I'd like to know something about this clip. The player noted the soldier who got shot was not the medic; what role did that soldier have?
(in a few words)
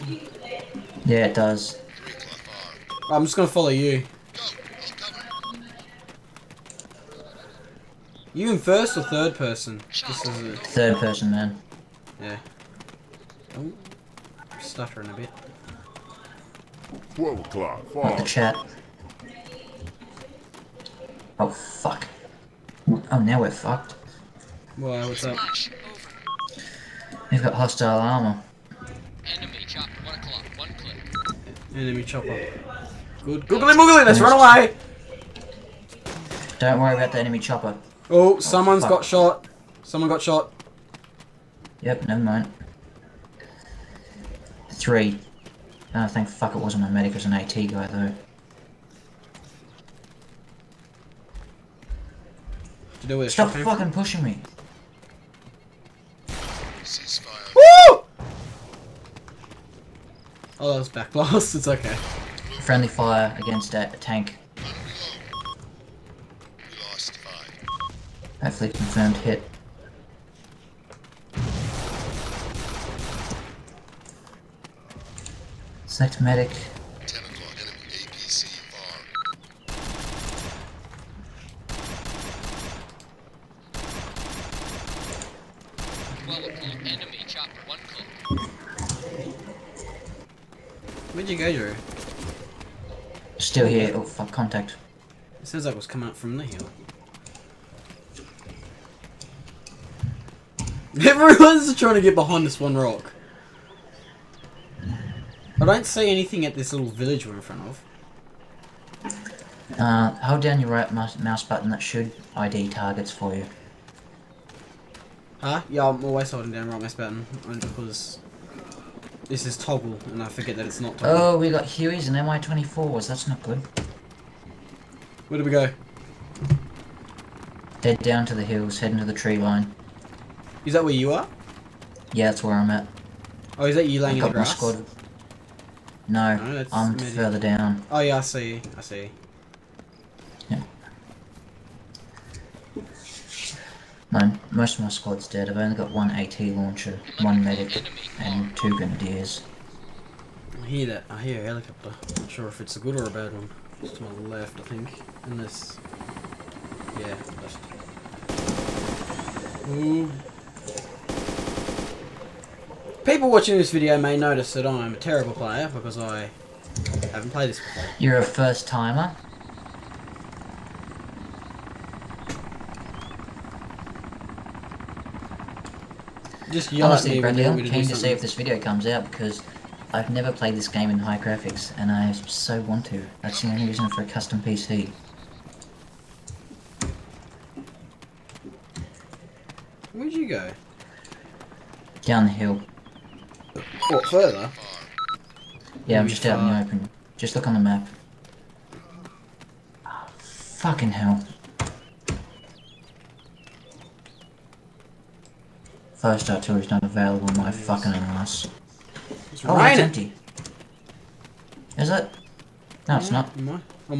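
AT guy.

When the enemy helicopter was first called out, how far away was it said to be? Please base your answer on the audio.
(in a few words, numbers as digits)
1 click.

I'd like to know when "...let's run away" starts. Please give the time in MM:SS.
00:34.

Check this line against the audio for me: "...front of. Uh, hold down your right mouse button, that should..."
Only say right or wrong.
right.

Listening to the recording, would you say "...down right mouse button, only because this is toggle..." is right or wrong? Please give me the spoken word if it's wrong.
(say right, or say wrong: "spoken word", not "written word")
right.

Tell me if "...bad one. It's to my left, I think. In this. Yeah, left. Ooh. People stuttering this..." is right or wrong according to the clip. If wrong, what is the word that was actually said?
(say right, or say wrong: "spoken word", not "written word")
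wrong: "watching", not "stuttering".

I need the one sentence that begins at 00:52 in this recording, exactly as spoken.
Do you know where Stop fucking from?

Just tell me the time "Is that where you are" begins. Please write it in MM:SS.
02:10.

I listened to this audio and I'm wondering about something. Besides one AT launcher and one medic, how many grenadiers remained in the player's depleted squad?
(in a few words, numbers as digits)
2.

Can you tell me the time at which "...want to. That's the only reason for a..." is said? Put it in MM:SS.
03:02.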